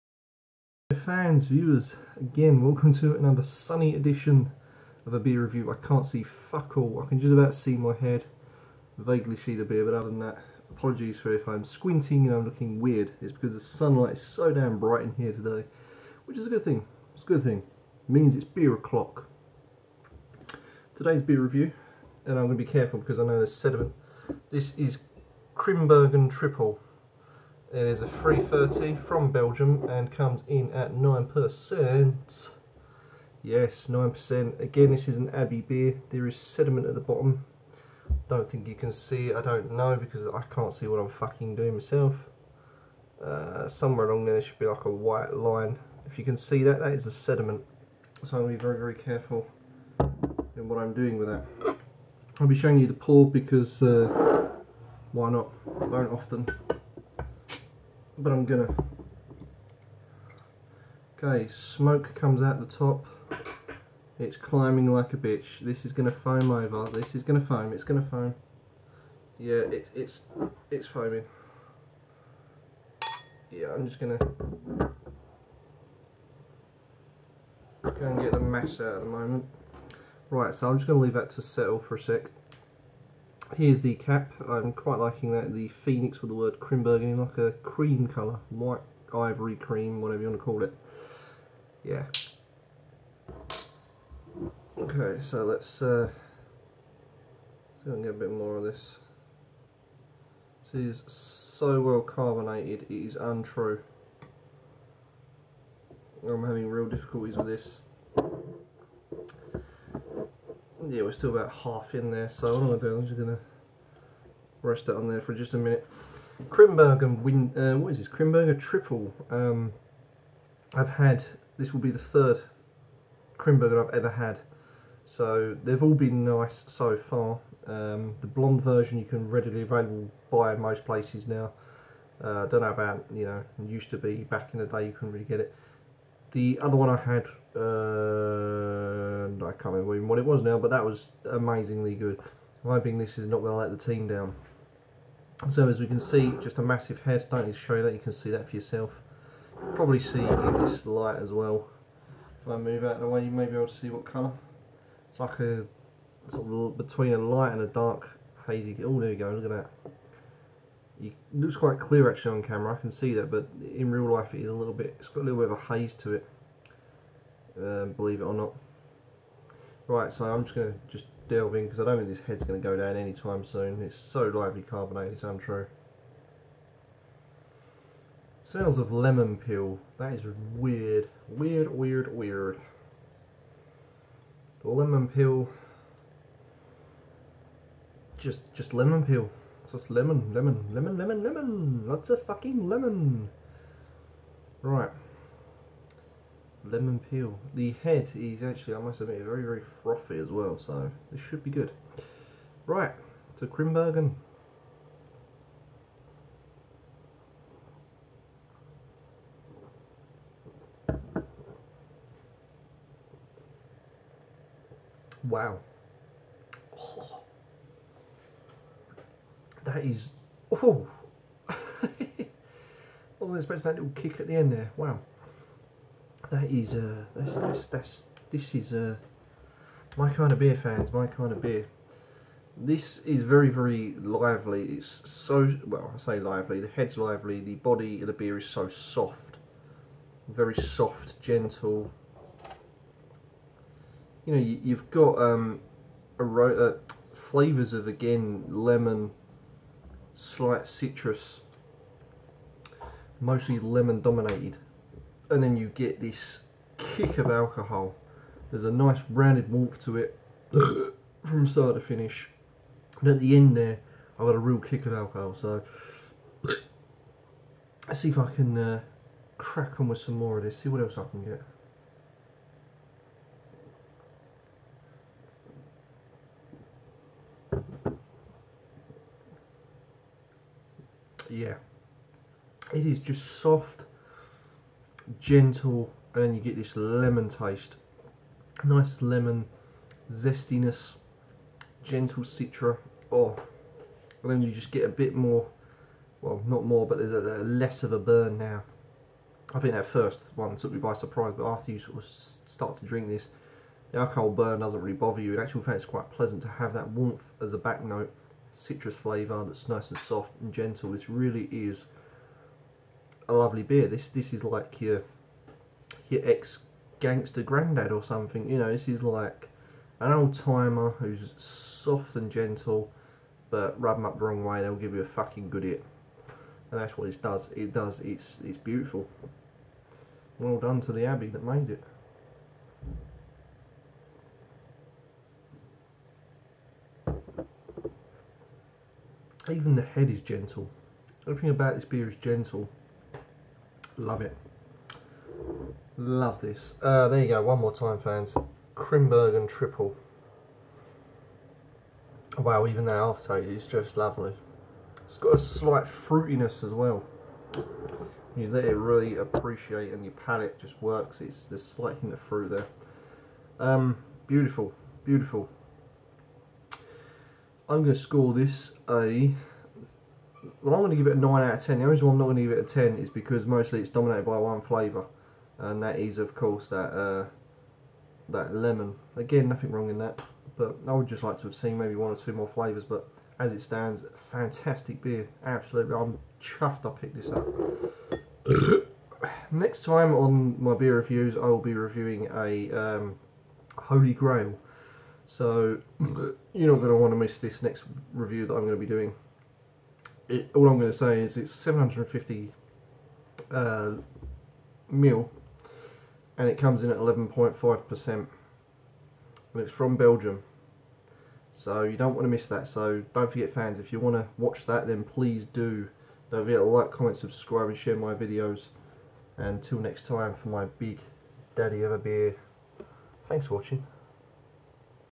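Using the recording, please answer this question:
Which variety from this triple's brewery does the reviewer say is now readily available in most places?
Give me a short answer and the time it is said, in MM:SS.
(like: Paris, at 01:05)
The blonde version, at 02:08.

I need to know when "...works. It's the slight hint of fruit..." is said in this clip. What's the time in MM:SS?
06:00.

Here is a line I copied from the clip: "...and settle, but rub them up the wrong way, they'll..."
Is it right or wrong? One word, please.
wrong.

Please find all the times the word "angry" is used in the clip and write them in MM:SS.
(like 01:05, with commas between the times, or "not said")
not said.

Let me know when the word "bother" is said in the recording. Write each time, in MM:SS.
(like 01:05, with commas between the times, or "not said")
05:04.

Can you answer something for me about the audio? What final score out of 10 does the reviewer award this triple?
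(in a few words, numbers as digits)
9.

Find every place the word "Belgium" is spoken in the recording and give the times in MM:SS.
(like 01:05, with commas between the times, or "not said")
00:29, 06:49.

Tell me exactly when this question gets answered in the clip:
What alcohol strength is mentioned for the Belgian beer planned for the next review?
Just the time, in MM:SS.
06:46.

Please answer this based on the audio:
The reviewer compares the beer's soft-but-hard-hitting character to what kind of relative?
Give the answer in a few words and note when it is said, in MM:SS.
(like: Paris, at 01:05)
Ex gangster granddad, at 05:16.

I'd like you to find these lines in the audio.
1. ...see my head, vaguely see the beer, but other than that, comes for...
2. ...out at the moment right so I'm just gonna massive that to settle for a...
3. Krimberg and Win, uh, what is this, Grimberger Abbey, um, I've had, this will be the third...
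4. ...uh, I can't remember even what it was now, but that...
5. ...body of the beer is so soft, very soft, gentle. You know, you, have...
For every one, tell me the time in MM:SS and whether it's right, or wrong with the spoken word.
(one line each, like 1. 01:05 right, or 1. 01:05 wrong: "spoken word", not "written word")
1. 00:07 wrong: "apologies", not "comes"
2. 01:18 wrong: "leave", not "massive"
3. 01:56 wrong: "Triple", not "Abbey"
4. 02:17 right
5. 03:57 right.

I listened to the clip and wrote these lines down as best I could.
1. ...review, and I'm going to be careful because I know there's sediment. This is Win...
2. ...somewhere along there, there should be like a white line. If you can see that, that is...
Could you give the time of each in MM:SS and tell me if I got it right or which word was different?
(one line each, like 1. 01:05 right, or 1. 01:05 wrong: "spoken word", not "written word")
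1. 00:21 wrong: "Grimbergen", not "Win"
2. 00:43 right.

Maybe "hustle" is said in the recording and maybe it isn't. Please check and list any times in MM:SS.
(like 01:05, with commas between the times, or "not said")
not said.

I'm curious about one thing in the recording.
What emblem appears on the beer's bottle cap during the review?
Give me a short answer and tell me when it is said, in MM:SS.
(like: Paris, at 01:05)
The phoenix, at 01:25.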